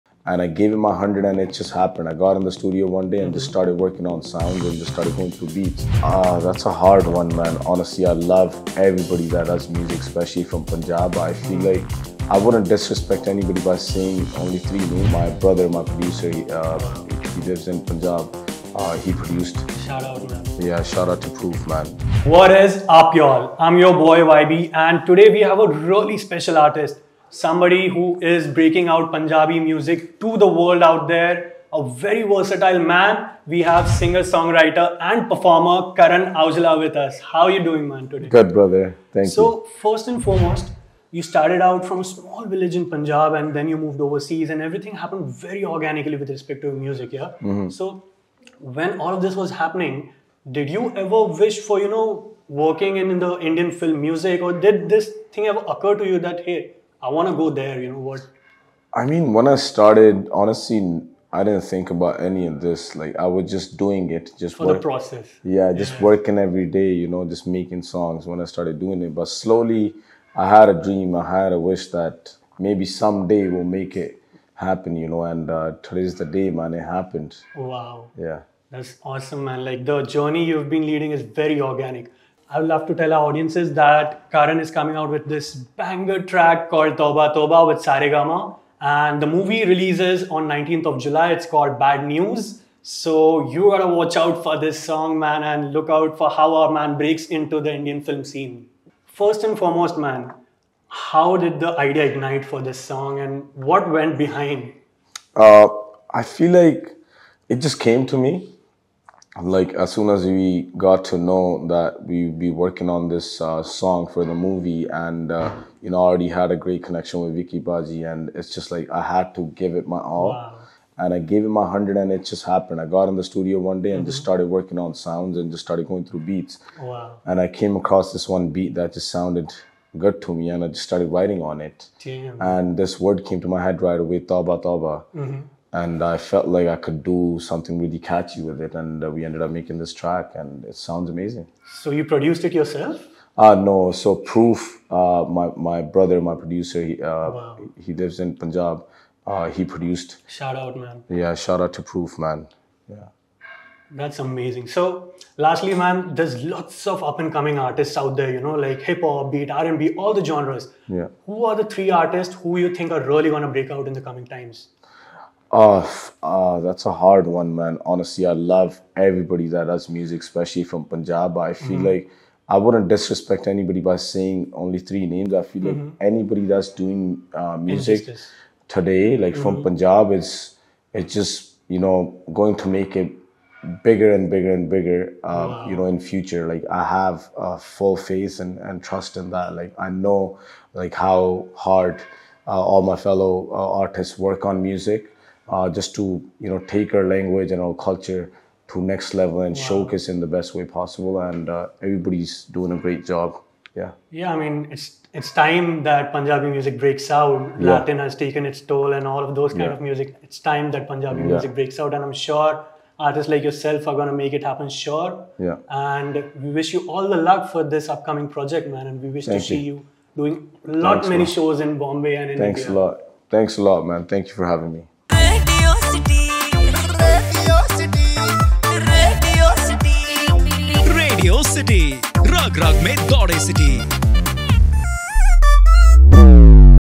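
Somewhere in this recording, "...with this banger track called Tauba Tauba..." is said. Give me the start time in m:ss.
1:25.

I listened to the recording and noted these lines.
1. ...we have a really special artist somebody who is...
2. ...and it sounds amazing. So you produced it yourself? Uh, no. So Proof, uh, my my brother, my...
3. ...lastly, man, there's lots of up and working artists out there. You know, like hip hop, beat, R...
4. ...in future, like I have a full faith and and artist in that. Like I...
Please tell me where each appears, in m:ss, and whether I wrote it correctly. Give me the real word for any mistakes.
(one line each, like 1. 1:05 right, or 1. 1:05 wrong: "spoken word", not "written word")
1. 0:25 right
2. 2:20 right
3. 2:35 wrong: "coming", not "working"
4. 3:05 wrong: "trust", not "artist".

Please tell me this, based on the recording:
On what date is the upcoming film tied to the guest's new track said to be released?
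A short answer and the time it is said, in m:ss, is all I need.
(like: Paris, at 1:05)
19th of July, at 1:30.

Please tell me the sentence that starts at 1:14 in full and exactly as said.
You know, and uh, today's the day, man.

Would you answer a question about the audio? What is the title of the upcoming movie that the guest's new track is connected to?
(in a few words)
Bad News.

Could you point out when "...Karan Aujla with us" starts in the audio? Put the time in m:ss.
0:35.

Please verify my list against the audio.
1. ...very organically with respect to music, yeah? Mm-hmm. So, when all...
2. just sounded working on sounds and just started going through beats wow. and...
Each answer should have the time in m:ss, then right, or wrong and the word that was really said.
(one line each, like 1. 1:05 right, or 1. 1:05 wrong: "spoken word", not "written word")
1. 0:45 right
2. 2:04 wrong: "started", not "sounded".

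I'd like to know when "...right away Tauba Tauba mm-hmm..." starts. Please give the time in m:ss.
2:13.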